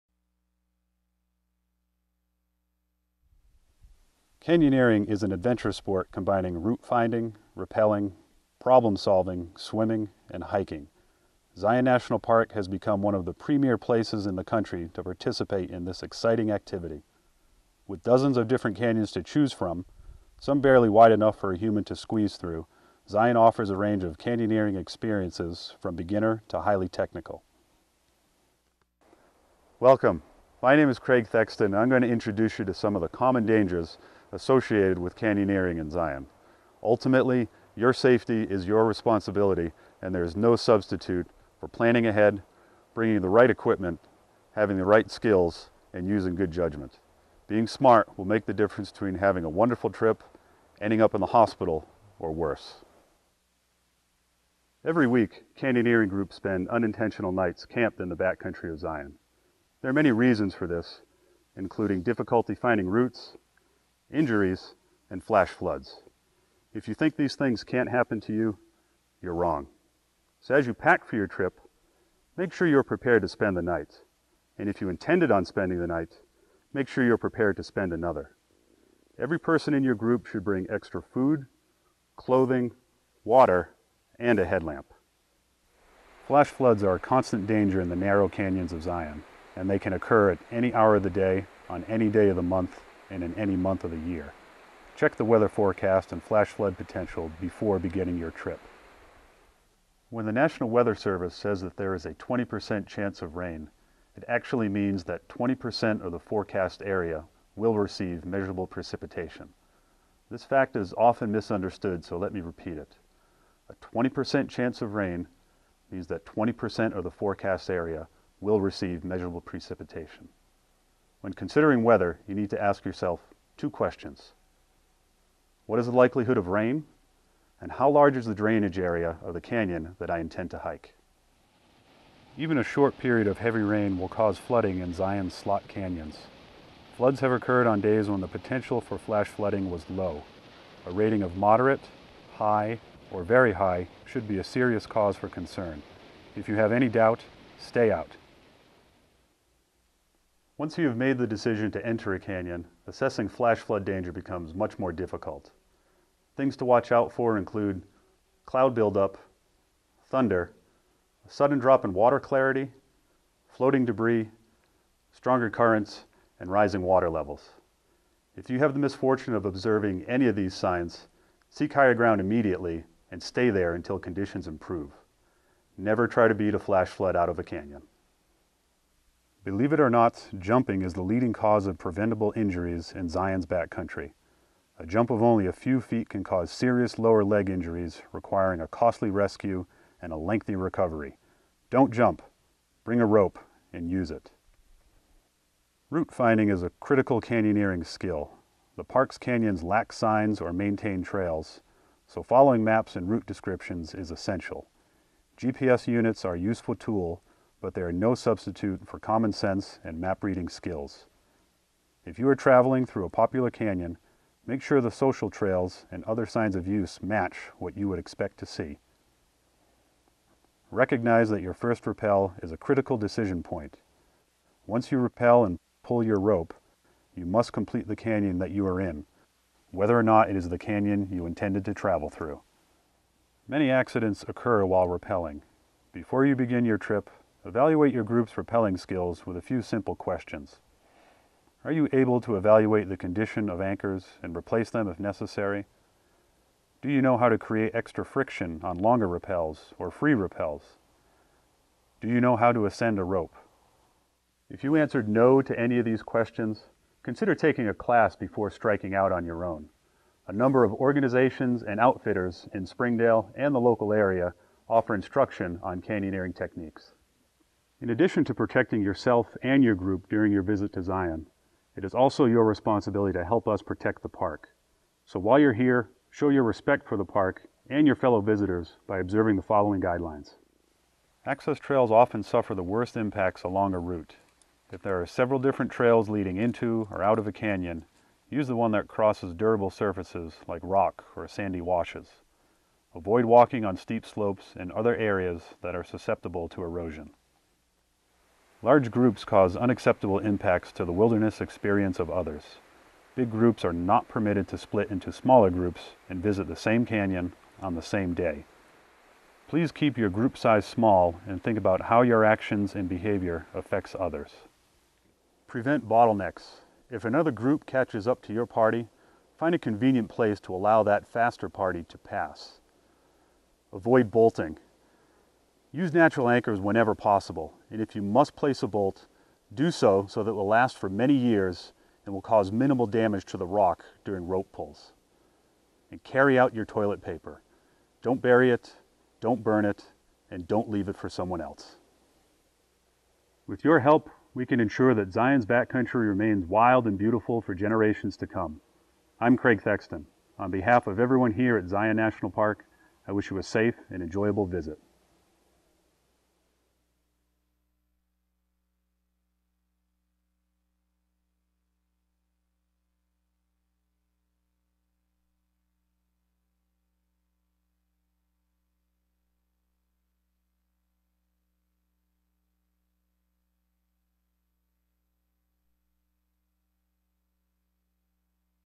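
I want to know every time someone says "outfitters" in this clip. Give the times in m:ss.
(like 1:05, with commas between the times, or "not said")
4:21.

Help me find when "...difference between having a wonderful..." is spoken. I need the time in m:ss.
0:48.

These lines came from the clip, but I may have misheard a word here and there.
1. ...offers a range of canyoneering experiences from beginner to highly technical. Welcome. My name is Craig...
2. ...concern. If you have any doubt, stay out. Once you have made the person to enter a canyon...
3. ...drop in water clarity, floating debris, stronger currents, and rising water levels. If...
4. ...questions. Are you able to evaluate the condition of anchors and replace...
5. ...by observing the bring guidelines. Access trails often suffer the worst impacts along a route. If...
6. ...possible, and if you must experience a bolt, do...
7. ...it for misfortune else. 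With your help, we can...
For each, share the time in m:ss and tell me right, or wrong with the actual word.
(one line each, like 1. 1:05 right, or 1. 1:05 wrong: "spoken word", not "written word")
1. 0:23 right
2. 2:25 wrong: "decision", not "person"
3. 2:41 right
4. 3:59 right
5. 4:38 wrong: "following", not "bring"
6. 5:26 wrong: "place", not "experience"
7. 5:40 wrong: "someone", not "misfortune".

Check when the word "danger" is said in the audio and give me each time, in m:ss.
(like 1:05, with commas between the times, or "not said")
0:33, 1:27, 2:33.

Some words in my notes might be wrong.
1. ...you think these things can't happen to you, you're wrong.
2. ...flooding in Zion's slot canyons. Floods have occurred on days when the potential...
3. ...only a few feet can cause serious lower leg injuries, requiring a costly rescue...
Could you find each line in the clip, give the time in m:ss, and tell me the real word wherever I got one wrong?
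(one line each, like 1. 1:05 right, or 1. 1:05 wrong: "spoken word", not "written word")
1. 1:06 right
2. 2:14 right
3. 3:05 right.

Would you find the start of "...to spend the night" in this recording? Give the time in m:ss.
1:13.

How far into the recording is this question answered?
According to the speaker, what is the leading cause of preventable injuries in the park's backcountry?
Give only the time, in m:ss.
3:00.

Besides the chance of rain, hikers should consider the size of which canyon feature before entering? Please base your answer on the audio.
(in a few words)
drainage area.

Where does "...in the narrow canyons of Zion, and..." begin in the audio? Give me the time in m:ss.
1:27.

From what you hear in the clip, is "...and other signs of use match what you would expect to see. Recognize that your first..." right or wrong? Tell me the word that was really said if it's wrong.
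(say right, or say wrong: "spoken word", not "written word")
right.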